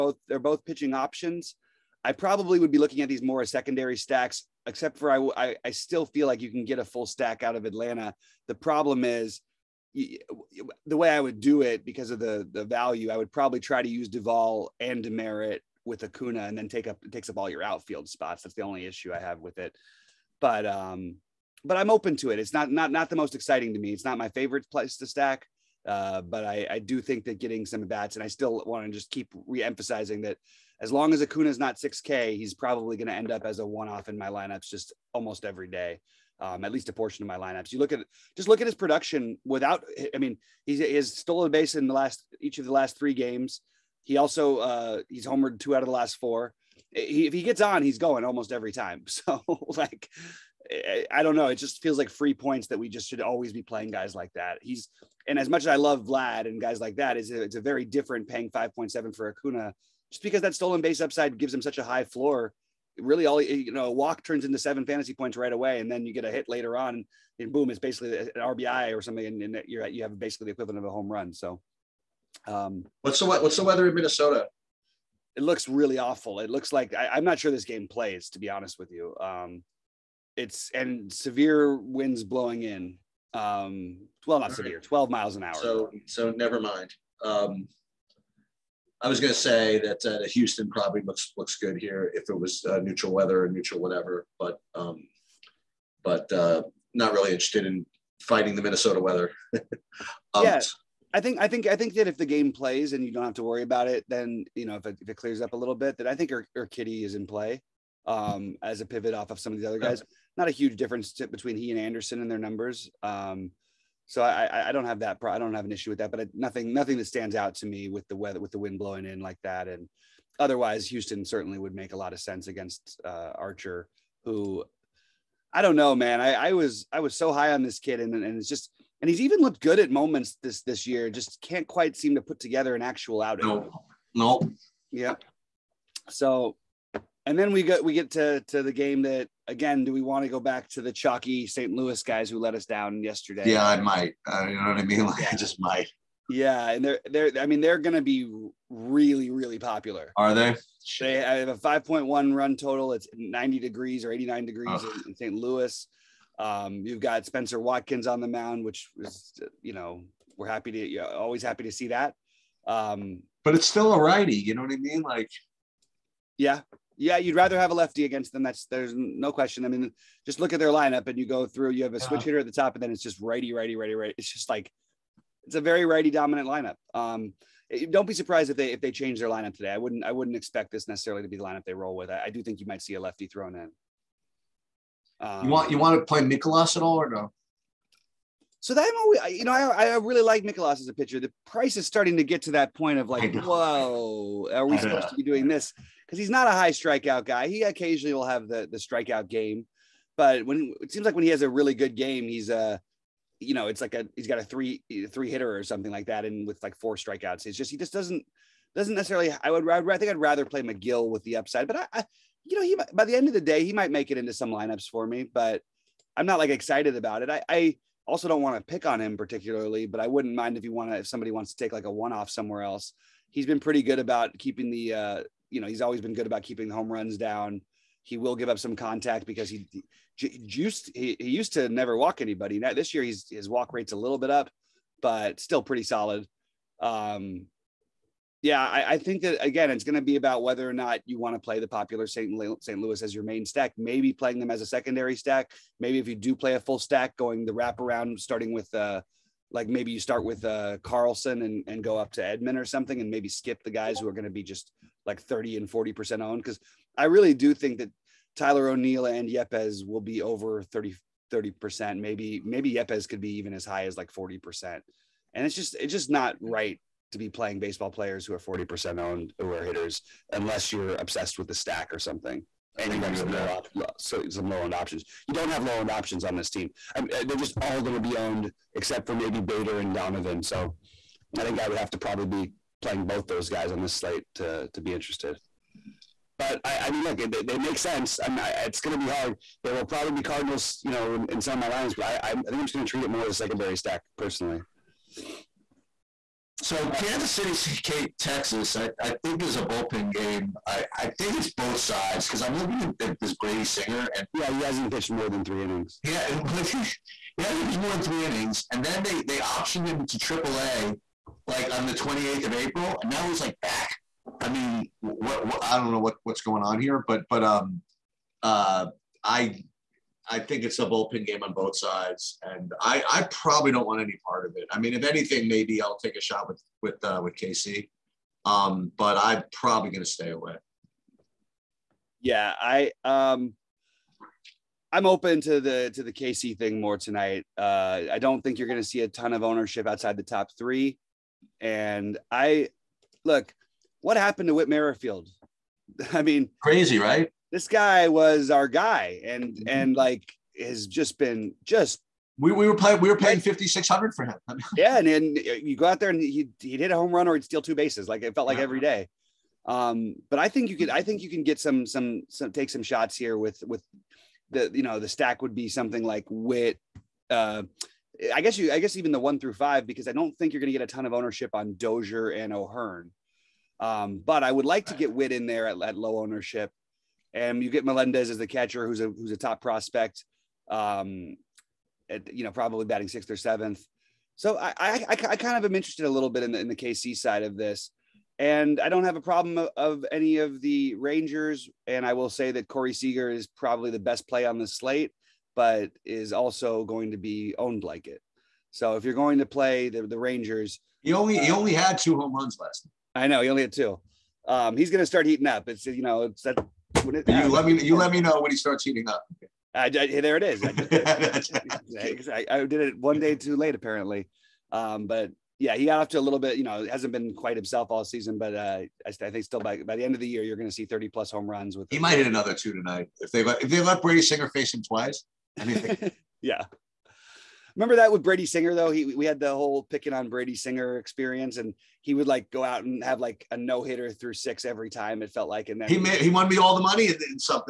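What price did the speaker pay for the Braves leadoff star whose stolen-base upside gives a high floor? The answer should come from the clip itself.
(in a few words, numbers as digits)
5.7.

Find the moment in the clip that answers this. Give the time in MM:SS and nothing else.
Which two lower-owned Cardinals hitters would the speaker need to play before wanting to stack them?
04:39.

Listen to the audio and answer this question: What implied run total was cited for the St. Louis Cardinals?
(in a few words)
5.1.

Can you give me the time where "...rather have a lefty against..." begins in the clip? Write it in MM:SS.
02:47.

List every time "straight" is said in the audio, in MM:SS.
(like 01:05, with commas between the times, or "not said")
not said.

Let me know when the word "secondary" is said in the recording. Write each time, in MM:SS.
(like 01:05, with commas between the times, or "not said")
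00:03, 04:04, 04:53.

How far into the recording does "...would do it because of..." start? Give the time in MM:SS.
00:11.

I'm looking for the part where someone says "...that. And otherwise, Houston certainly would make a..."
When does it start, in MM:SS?
01:59.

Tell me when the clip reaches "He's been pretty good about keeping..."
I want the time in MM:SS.
03:43.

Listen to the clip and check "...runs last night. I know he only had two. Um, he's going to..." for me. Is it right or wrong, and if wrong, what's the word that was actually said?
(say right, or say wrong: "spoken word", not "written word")
right.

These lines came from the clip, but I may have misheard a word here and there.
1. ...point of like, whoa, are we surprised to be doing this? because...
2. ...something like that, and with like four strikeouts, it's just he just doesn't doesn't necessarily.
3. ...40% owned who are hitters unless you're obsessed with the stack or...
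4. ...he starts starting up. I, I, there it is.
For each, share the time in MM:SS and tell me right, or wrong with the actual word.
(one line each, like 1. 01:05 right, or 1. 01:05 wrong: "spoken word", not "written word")
1. 03:12 wrong: "supposed", not "surprised"
2. 03:25 right
3. 04:28 right
4. 06:48 wrong: "heating", not "starting".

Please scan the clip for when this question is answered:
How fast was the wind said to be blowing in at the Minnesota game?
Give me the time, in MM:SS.
01:24.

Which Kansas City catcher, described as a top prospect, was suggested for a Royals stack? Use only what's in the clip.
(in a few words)
Melendez.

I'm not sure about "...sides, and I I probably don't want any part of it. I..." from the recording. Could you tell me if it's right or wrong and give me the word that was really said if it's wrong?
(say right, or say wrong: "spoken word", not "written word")
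right.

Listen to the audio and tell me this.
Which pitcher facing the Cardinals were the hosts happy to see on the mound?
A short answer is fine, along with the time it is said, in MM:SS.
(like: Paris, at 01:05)
Spenser Watkins, at 02:37.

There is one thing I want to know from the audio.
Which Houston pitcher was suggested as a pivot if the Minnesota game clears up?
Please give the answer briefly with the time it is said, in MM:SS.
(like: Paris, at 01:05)
Urquidy, at 01:46.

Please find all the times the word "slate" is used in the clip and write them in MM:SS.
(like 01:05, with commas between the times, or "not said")
04:43, 06:34.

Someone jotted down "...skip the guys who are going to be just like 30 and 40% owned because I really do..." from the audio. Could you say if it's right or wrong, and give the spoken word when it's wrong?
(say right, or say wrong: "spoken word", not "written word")
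right.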